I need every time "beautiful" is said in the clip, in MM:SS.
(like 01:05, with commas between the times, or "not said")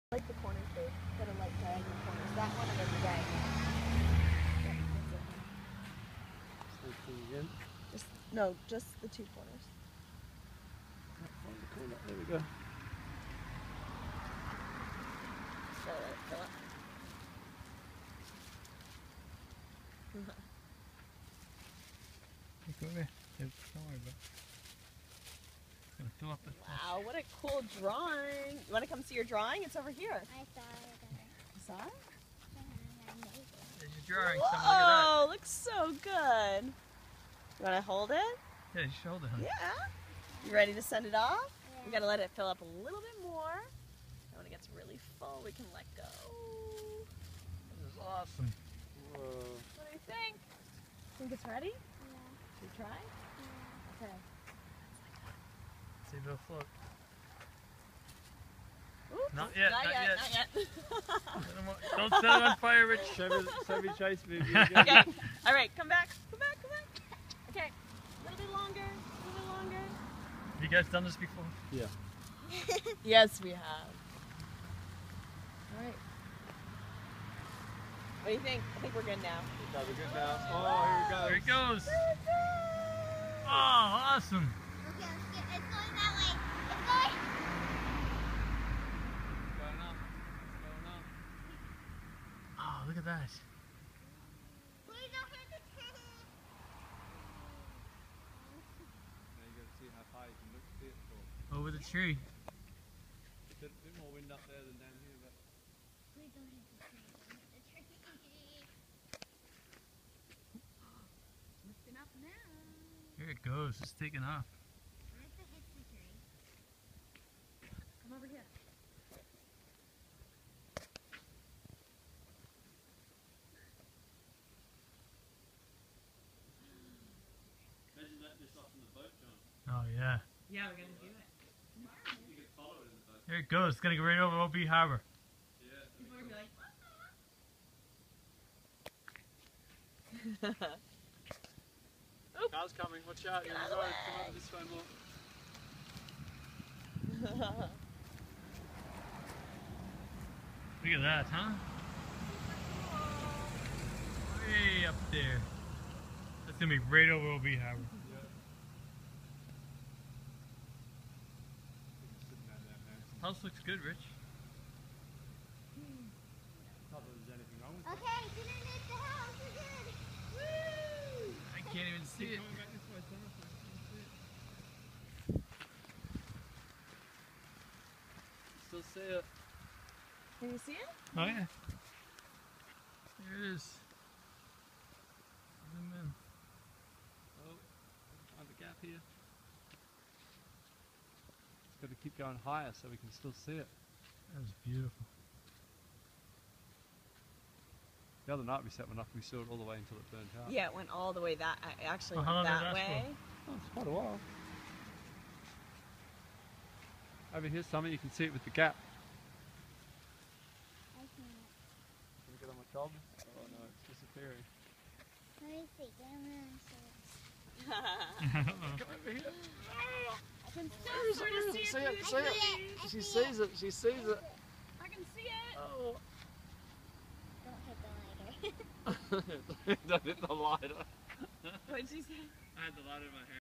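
03:14.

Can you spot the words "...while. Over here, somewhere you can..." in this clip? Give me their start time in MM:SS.
03:23.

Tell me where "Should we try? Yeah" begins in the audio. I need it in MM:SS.
00:52.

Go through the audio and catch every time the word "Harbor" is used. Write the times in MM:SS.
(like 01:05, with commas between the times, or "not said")
02:14, 02:37.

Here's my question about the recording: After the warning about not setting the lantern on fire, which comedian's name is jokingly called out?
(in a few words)
Chevy Chase.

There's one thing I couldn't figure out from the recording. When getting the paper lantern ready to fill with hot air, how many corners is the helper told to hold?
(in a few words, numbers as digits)
2.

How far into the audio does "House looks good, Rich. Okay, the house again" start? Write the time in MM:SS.
02:43.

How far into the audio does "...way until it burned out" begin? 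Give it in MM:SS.
03:19.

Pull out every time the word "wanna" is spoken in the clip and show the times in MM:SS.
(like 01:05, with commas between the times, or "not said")
00:28.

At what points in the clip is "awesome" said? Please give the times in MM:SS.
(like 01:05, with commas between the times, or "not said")
00:48, 01:23.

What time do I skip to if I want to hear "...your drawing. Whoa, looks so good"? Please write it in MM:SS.
00:34.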